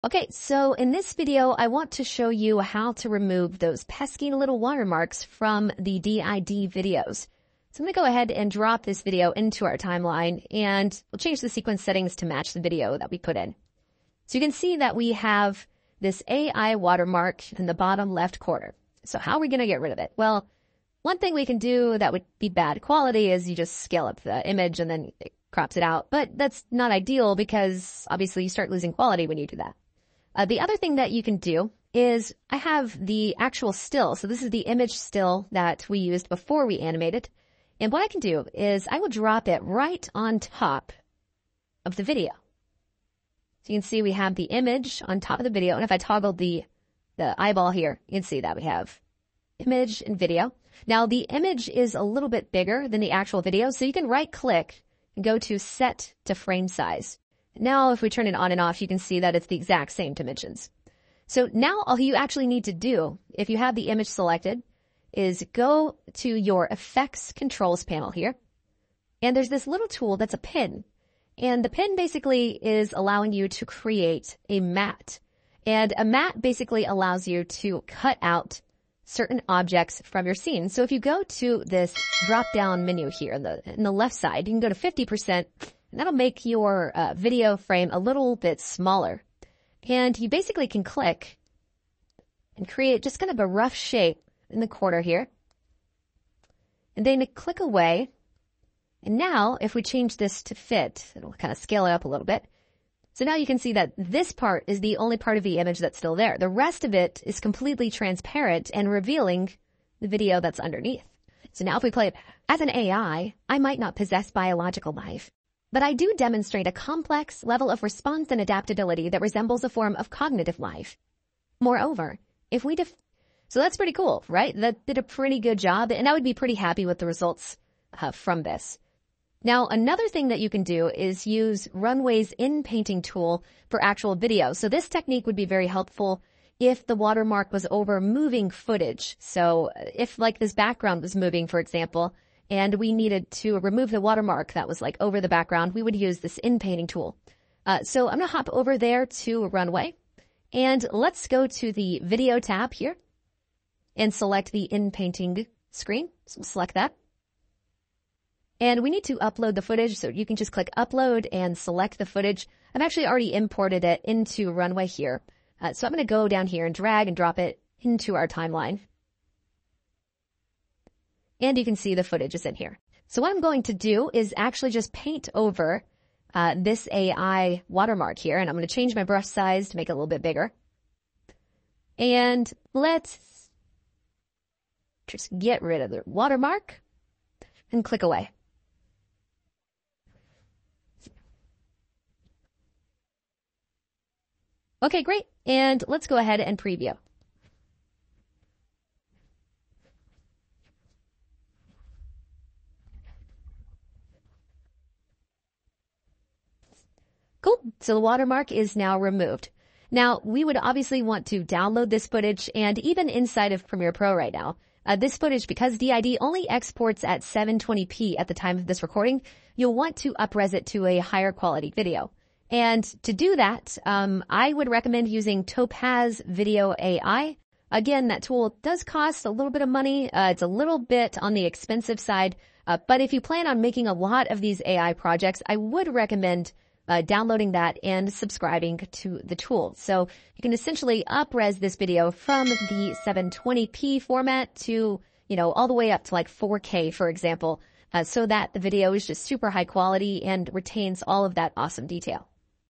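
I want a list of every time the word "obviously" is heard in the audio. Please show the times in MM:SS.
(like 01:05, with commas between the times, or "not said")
00:28, 03:30.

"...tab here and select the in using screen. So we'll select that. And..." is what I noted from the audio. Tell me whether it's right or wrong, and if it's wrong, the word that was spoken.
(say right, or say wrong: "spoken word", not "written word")
wrong: "painting", not "using".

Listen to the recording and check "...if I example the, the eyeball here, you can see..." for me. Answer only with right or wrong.
wrong.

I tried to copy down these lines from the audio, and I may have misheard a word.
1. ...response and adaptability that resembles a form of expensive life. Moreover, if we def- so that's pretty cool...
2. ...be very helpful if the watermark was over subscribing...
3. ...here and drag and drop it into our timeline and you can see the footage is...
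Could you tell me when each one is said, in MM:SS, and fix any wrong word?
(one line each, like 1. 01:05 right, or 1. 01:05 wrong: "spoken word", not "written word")
1. 01:57 wrong: "cognitive", not "expensive"
2. 02:15 wrong: "moving", not "subscribing"
3. 02:46 right.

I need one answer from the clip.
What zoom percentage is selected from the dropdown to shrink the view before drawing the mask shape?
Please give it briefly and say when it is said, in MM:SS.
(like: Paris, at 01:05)
50%, at 01:24.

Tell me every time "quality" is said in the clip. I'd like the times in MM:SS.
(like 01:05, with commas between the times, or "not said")
00:22, 00:28, 03:41, 04:09.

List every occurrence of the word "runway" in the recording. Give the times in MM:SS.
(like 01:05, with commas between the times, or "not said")
02:11, 02:29, 02:44.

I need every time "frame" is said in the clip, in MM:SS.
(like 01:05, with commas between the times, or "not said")
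00:56, 01:27.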